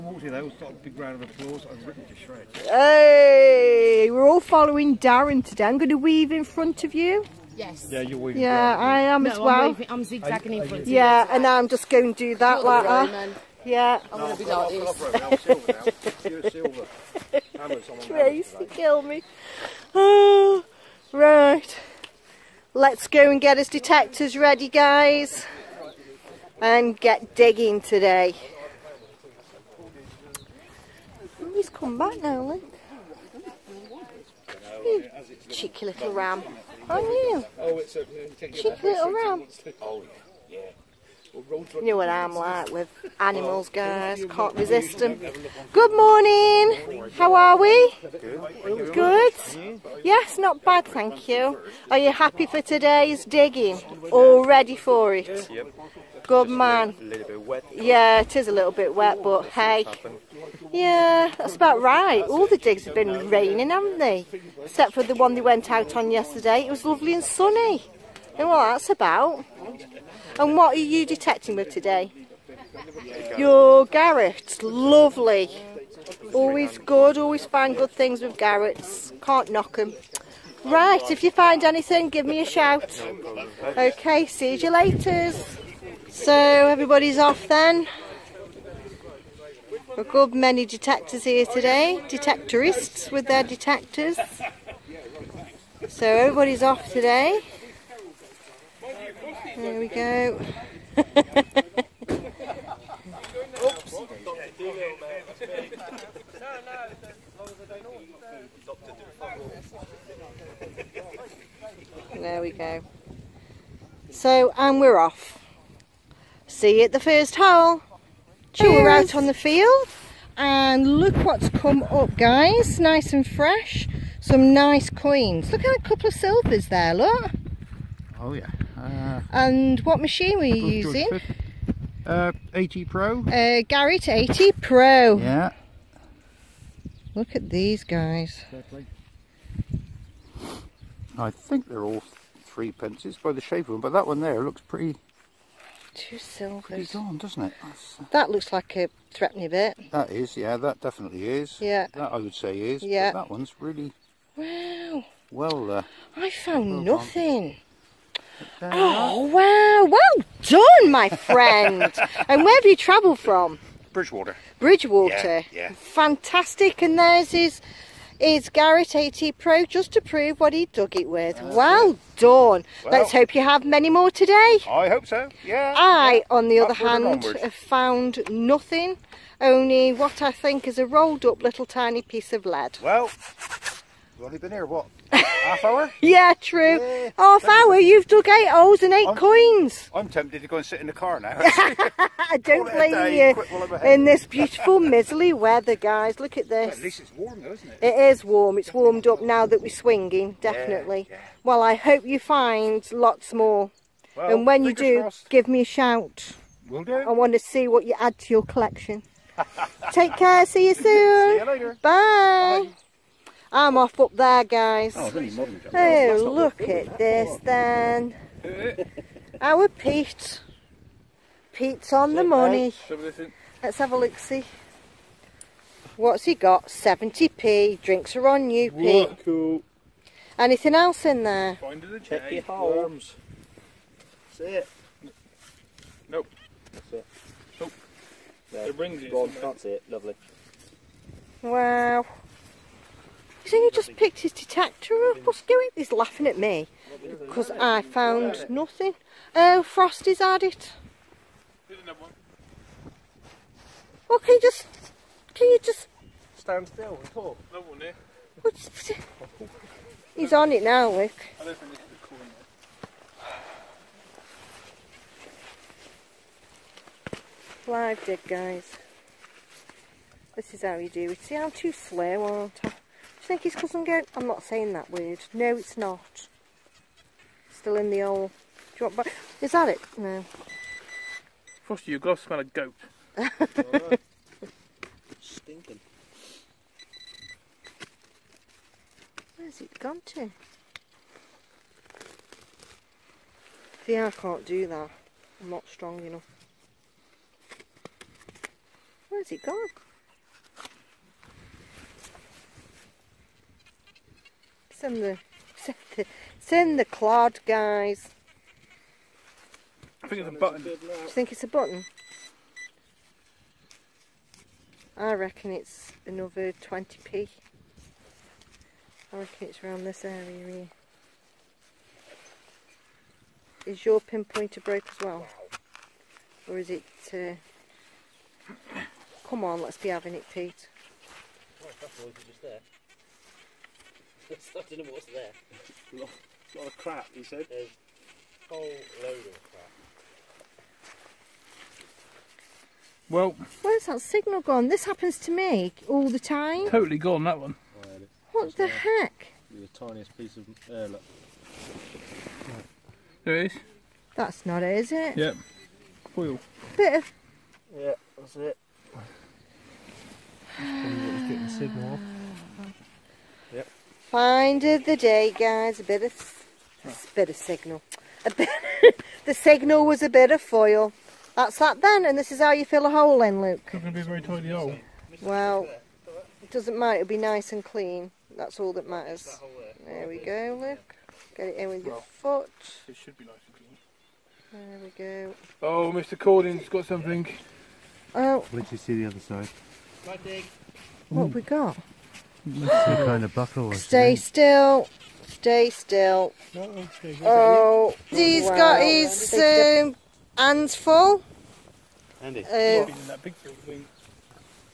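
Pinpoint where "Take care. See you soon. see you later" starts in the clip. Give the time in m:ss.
3:29.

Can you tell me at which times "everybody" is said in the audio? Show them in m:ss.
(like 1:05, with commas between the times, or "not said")
1:26, 1:36.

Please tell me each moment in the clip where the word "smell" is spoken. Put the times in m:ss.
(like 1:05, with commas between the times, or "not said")
4:42.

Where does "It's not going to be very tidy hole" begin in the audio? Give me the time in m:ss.
6:13.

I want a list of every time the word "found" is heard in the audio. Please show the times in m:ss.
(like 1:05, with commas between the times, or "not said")
2:36, 2:57, 4:07.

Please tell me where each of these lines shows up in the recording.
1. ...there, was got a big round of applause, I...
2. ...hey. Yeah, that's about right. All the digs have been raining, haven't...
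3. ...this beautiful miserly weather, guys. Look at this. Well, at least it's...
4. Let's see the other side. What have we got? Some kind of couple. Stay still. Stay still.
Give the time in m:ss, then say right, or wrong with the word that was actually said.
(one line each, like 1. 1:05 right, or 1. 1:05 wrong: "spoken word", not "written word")
1. 0:00 right
2. 0:59 right
3. 3:14 right
4. 6:28 wrong: "buckle", not "couple".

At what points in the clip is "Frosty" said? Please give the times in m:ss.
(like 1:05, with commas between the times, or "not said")
4:09, 4:41.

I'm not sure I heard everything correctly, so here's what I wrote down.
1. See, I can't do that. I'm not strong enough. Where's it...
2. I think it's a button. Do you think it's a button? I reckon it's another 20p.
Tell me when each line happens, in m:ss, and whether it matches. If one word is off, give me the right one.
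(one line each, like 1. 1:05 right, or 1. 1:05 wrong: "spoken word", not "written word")
1. 4:53 right
2. 5:10 right.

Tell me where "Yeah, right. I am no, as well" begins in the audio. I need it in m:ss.
0:08.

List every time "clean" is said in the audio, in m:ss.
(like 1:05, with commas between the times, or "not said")
6:17, 6:24.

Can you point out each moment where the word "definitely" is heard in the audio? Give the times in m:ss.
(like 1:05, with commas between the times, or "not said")
2:30, 3:20.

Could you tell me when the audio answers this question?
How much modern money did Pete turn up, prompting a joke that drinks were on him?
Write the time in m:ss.
3:46.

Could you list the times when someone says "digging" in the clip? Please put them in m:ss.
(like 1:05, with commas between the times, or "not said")
0:27, 0:53.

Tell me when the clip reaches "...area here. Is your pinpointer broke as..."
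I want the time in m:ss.
5:20.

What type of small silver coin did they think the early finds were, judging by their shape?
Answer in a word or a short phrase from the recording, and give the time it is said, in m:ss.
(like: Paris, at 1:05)
Threepenny bit, at 2:29.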